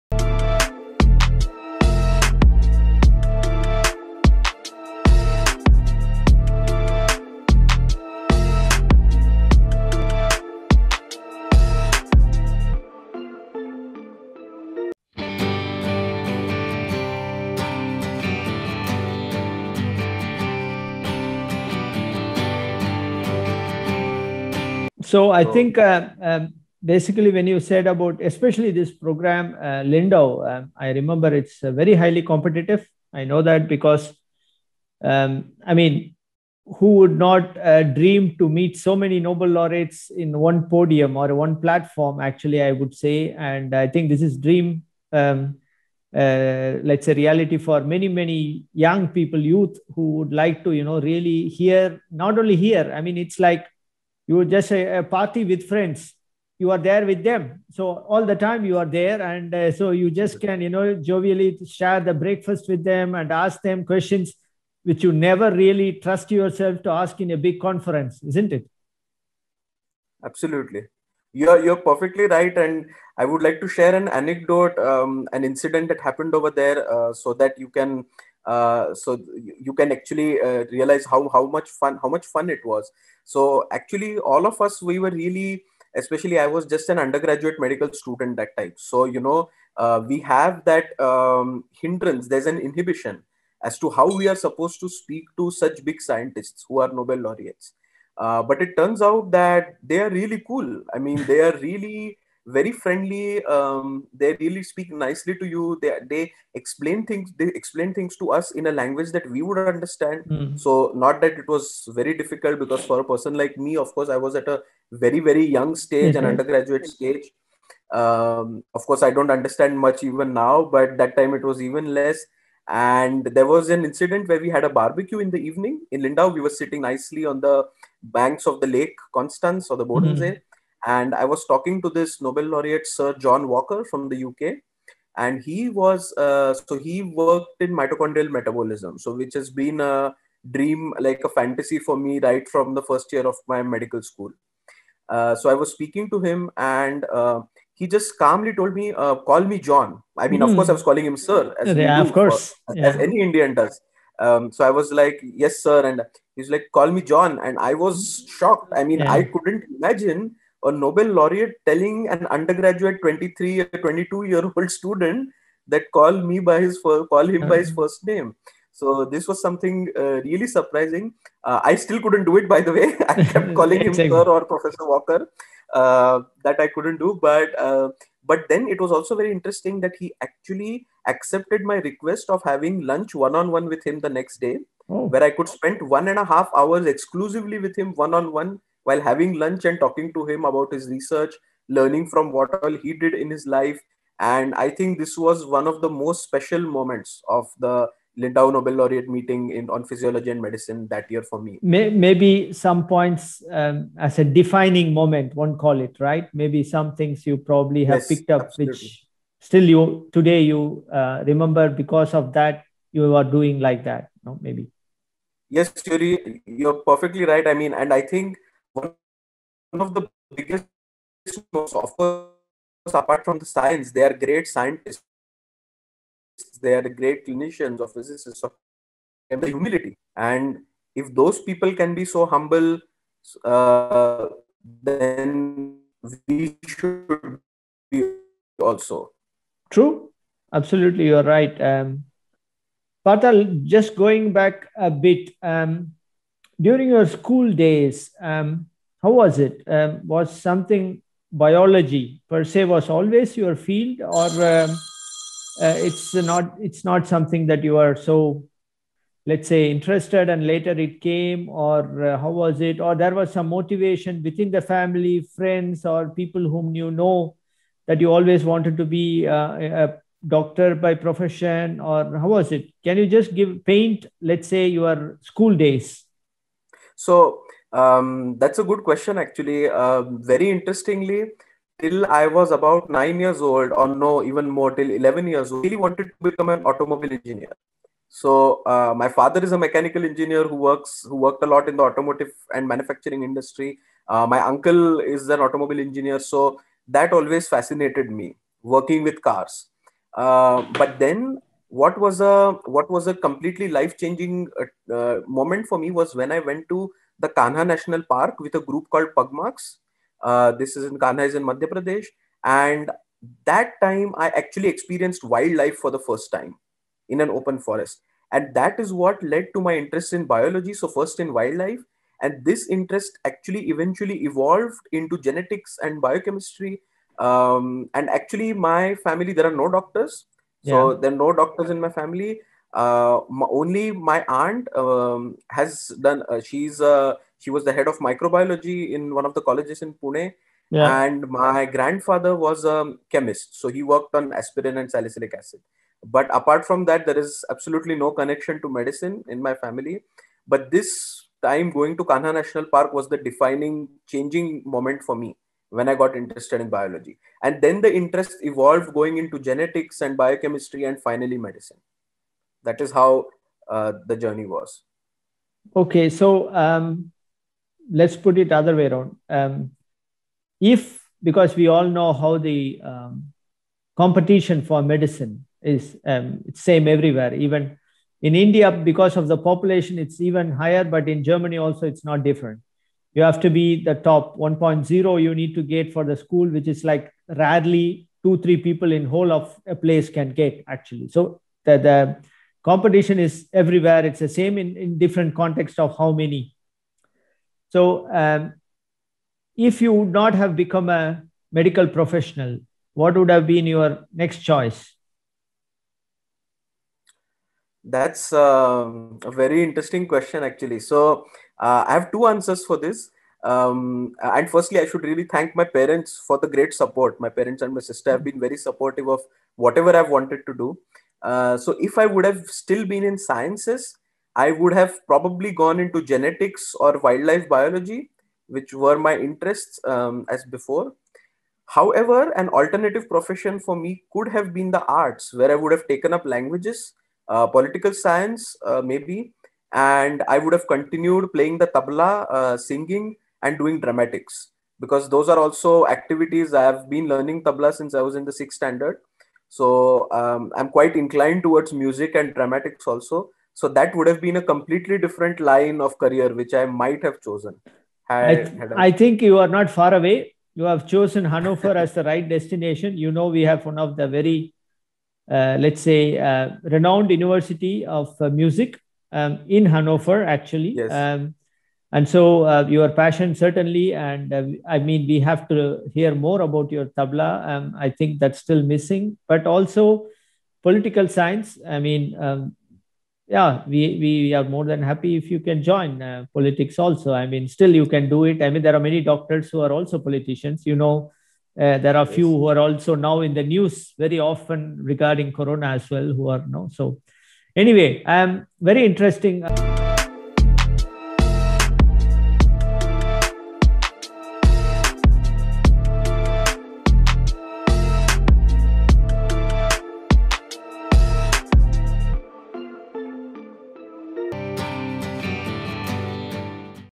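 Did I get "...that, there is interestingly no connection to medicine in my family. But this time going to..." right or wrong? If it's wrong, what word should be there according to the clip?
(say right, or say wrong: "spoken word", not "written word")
wrong: "absolutely", not "interestingly".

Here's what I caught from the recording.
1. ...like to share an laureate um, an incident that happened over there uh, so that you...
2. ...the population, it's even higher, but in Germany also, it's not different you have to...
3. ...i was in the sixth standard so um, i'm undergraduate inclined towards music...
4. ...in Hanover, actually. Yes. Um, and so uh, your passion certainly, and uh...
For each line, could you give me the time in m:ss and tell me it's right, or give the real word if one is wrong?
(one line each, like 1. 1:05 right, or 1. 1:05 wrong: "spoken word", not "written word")
1. 1:13 wrong: "anecdote", not "laureate"
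2. 6:19 right
3. 7:27 wrong: "quite", not "undergraduate"
4. 7:49 right.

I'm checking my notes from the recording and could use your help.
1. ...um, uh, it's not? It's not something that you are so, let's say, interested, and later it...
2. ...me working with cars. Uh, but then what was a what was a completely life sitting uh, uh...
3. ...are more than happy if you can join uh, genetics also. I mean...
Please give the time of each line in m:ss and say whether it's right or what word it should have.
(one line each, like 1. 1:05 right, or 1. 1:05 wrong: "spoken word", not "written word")
1. 4:14 right
2. 4:58 wrong: "changing", not "sitting"
3. 8:04 wrong: "politics", not "genetics".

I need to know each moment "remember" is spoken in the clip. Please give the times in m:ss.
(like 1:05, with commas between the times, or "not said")
0:30, 3:31.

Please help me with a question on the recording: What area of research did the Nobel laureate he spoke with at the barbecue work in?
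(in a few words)
Mitochondrial metabolism.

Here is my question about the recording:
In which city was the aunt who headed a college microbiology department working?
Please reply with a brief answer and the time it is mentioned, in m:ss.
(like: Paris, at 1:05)
Pune, at 5:39.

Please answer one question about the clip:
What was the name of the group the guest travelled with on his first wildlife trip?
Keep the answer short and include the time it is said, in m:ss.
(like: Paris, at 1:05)
Pugmarks, at 5:09.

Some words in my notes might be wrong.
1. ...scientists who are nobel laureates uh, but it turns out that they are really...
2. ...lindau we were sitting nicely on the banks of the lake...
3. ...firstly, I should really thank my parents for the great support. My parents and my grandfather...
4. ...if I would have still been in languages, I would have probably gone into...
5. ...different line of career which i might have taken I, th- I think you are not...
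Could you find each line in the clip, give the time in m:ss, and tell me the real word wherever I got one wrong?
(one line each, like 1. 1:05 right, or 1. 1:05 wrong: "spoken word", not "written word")
1. 1:36 right
2. 2:06 right
3. 6:54 wrong: "sister", not "grandfather"
4. 7:01 wrong: "sciences", not "languages"
5. 7:34 wrong: "chosen", not "taken".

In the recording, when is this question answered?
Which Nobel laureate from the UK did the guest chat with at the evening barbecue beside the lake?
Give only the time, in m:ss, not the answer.
2:12.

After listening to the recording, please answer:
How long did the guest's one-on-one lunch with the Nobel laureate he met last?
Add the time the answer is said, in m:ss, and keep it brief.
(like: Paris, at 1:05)
1.5 hours, at 3:05.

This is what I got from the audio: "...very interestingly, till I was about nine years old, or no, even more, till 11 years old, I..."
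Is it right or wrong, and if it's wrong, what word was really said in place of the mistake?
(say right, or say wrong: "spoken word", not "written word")
right.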